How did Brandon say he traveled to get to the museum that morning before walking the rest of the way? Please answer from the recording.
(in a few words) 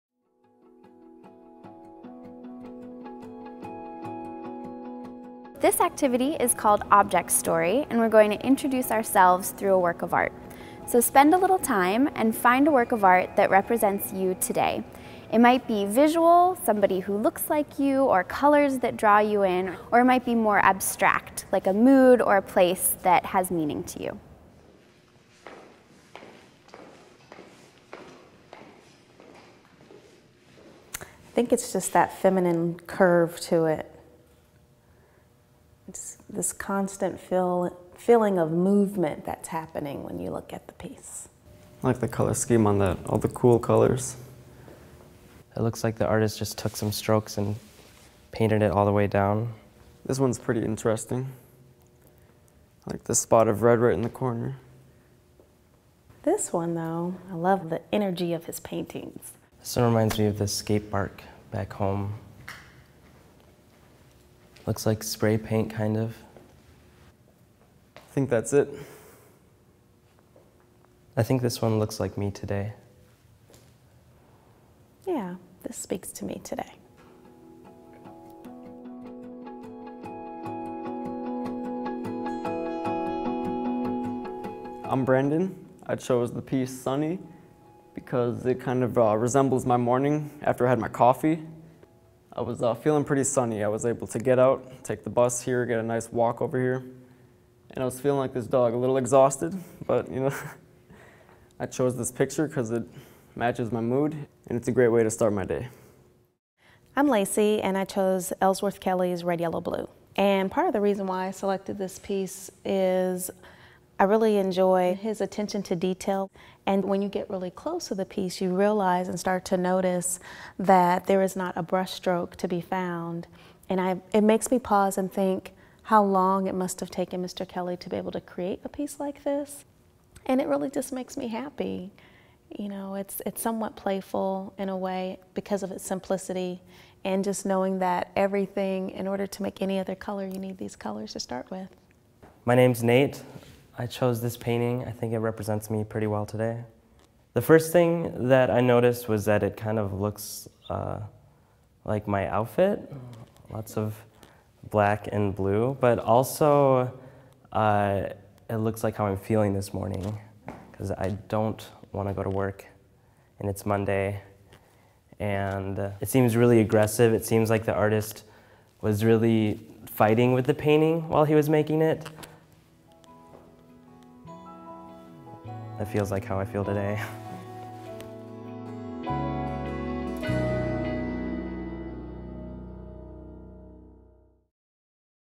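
the bus.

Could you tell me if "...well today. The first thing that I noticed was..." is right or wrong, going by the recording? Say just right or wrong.
right.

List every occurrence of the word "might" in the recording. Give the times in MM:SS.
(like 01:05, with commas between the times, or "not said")
00:15, 00:20.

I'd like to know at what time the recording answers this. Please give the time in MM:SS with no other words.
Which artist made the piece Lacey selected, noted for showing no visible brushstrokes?
01:48.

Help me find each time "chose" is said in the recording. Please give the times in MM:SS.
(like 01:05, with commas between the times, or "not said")
01:25, 01:41, 01:47, 02:23.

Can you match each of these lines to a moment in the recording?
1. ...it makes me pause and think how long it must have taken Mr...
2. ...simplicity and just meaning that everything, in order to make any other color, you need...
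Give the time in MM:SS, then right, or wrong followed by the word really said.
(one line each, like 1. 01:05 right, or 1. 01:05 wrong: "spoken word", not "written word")
1. 02:04 right
2. 02:15 wrong: "knowing", not "meaning".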